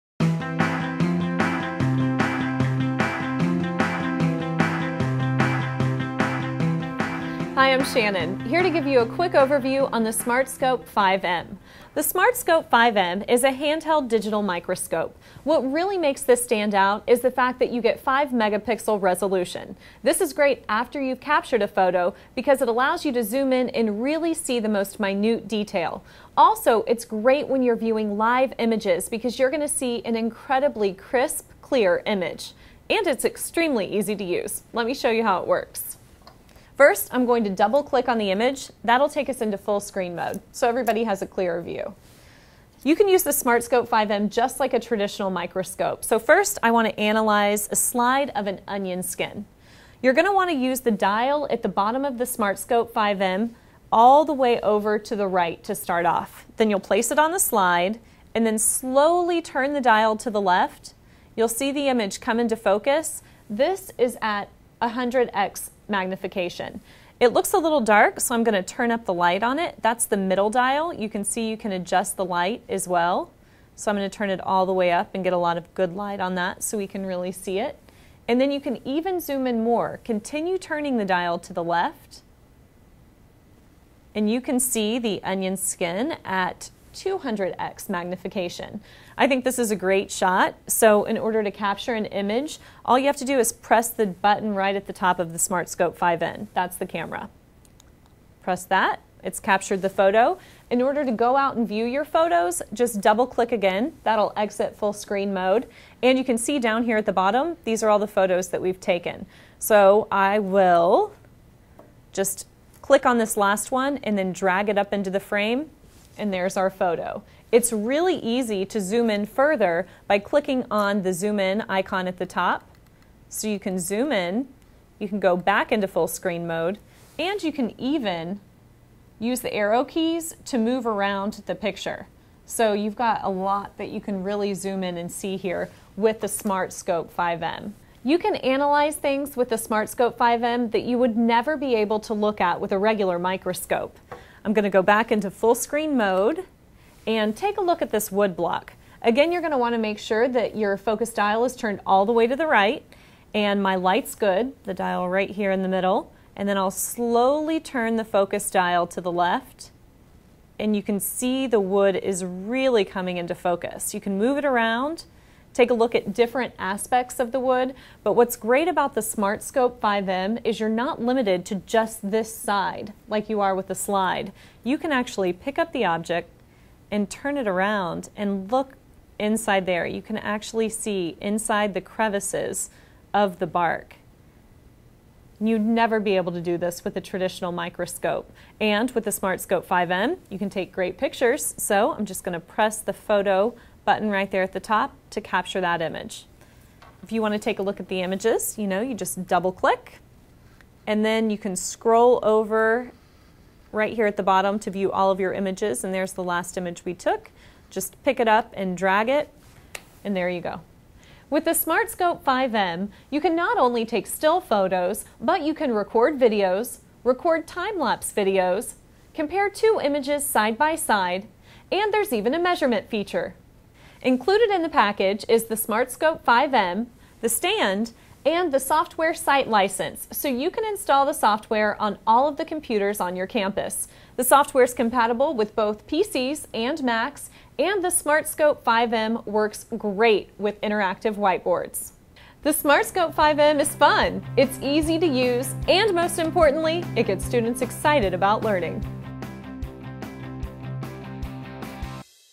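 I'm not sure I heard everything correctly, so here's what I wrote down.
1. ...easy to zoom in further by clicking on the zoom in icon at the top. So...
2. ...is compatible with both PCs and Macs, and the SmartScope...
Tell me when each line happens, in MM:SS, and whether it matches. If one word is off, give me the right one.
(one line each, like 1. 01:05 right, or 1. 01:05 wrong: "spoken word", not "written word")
1. 01:58 right
2. 03:54 right.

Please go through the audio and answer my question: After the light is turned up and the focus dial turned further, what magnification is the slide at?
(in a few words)
200x.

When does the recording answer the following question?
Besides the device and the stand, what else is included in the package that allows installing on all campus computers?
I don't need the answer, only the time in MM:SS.
03:48.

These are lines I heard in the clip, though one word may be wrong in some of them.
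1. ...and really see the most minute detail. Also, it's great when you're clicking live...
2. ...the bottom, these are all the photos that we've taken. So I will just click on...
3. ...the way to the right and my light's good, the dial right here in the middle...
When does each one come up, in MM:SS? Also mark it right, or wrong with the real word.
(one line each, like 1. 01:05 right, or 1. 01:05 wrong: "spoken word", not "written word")
1. 00:23 wrong: "viewing", not "clicking"
2. 01:47 right
3. 02:32 right.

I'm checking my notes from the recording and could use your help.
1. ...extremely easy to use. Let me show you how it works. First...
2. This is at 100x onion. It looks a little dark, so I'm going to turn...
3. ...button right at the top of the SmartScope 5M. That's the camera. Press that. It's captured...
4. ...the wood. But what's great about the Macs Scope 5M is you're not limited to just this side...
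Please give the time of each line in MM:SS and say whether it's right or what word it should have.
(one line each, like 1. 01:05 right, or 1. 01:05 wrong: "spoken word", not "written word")
1. 00:33 right
2. 01:03 wrong: "magnification", not "onion"
3. 01:34 right
4. 02:47 wrong: "Smart", not "Macs".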